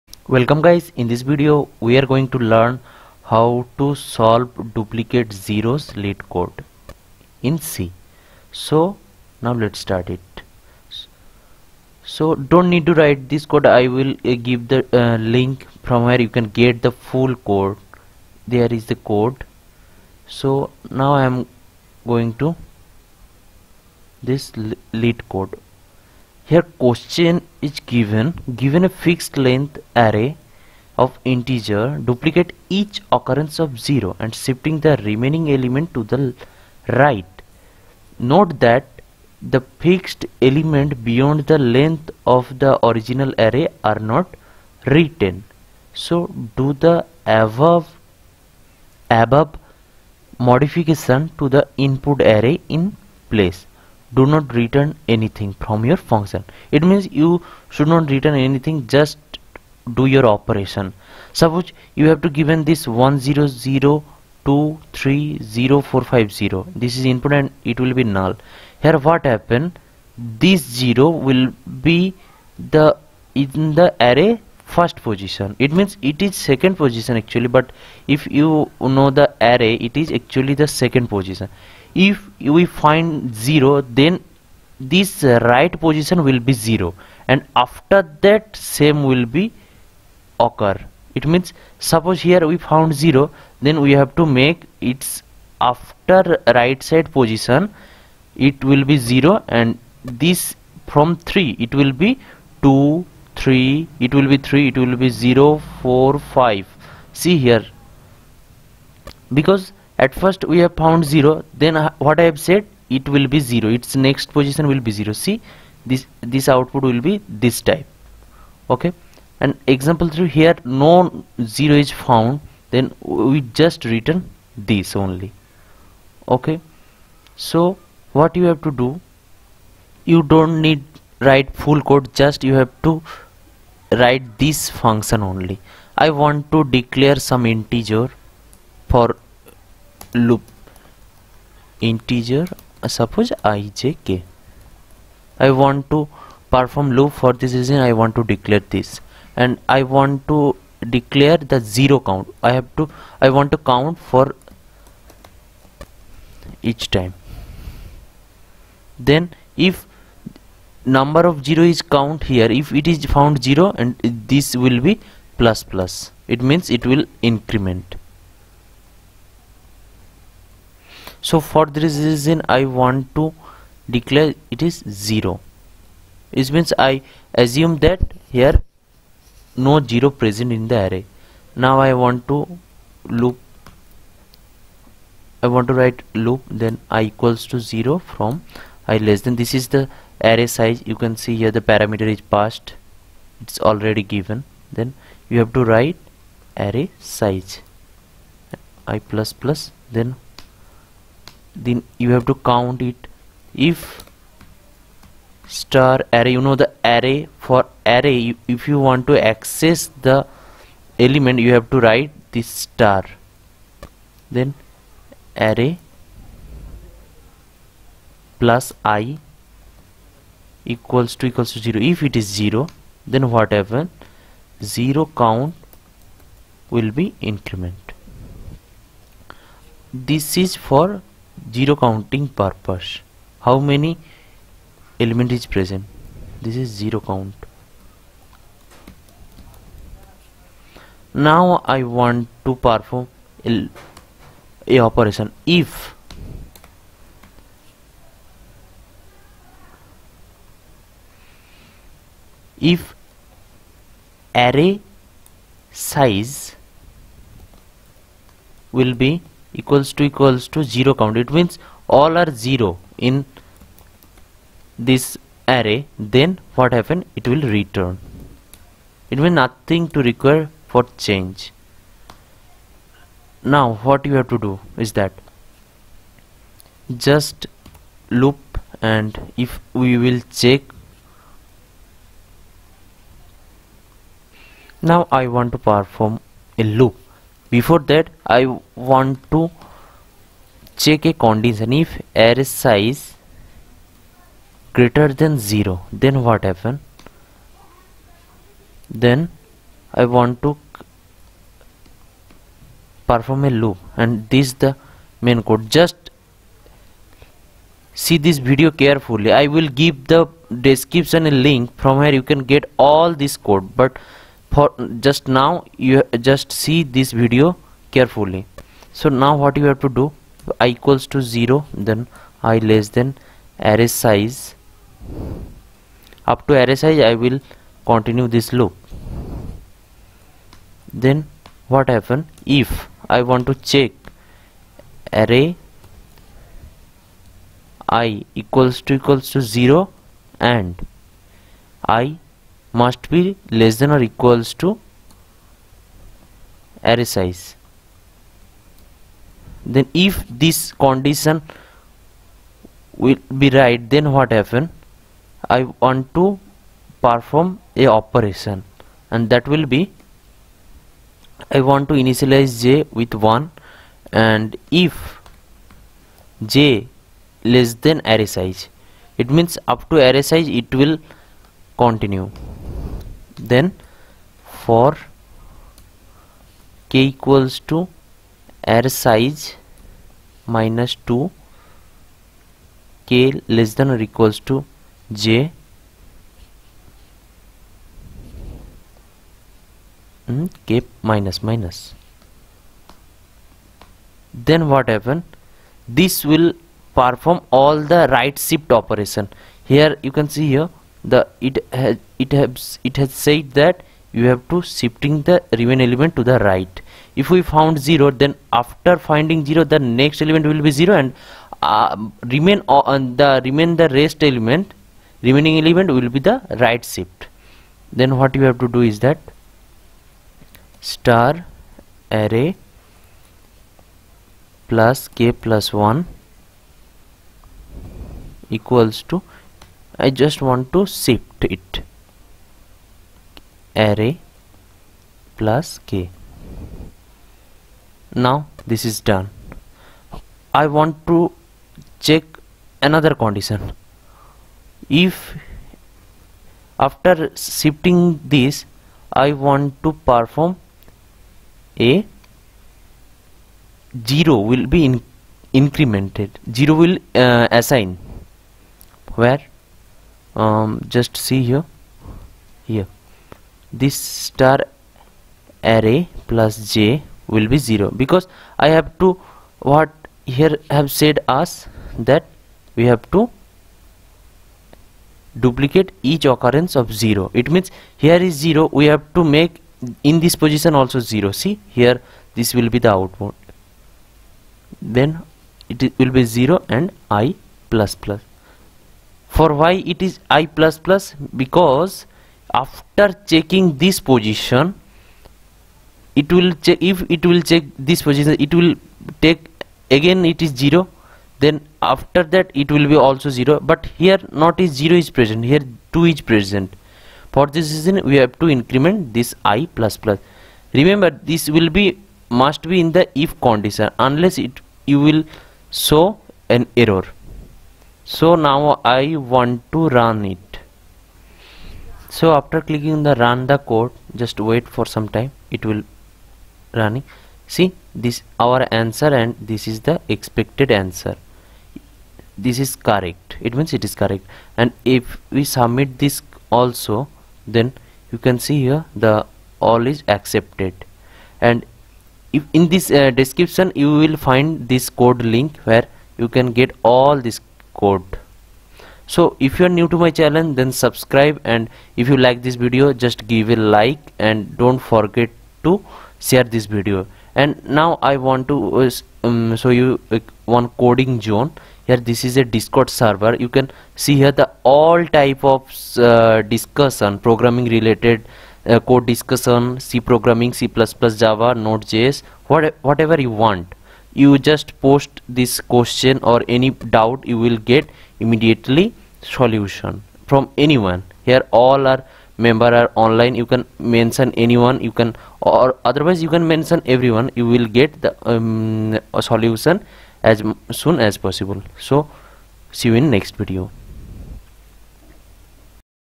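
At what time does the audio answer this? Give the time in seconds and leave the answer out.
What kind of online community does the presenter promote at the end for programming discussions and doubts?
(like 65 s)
562 s.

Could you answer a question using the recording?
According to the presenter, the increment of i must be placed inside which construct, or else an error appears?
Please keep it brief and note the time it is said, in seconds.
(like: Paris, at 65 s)
if condition, at 513 s.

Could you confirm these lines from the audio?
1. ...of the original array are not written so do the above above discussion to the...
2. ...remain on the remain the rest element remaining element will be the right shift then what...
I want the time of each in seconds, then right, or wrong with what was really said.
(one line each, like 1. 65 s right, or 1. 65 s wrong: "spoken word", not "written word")
1. 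42 s wrong: "modification", not "discussion"
2. 412 s right.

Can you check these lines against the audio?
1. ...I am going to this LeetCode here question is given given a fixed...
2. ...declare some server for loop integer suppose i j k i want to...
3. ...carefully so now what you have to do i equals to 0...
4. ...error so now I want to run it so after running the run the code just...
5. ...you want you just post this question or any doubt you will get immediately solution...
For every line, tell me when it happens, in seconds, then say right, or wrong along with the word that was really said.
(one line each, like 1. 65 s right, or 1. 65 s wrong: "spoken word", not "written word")
1. 21 s right
2. 136 s wrong: "integer", not "server"
3. 317 s right
4. 516 s wrong: "clicking", not "running"
5. 573 s right.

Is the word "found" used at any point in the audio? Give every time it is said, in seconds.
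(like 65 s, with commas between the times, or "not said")
92 s, 110 s, 122 s, 163 s, 407 s.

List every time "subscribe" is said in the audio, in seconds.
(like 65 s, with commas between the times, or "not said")
550 s.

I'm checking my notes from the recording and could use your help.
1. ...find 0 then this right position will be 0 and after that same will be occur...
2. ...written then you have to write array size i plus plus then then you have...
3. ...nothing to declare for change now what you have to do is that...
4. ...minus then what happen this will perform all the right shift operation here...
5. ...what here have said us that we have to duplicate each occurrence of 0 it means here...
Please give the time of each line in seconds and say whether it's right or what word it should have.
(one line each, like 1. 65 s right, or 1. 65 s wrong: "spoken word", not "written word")
1. 82 s right
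2. 194 s wrong: "given", not "written"
3. 269 s wrong: "require", not "declare"
4. 391 s right
5. 469 s right.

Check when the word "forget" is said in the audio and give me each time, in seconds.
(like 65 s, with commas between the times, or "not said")
554 s.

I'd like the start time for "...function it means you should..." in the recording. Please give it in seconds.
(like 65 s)
55 s.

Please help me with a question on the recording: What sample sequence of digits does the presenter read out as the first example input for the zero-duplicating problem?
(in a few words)
100230450.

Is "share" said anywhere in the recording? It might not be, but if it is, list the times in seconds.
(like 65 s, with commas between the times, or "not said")
556 s.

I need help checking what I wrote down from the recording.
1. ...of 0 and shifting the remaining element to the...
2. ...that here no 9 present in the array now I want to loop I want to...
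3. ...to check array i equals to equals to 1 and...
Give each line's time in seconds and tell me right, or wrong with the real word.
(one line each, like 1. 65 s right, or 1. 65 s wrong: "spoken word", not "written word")
1. 33 s right
2. 177 s wrong: "0", not "9"
3. 333 s wrong: "0", not "1".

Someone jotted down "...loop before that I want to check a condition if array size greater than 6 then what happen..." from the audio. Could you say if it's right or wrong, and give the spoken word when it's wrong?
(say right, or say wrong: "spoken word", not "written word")
wrong: "0", not "6".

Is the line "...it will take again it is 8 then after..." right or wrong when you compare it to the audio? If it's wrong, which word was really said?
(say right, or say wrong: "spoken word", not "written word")
wrong: "0", not "8".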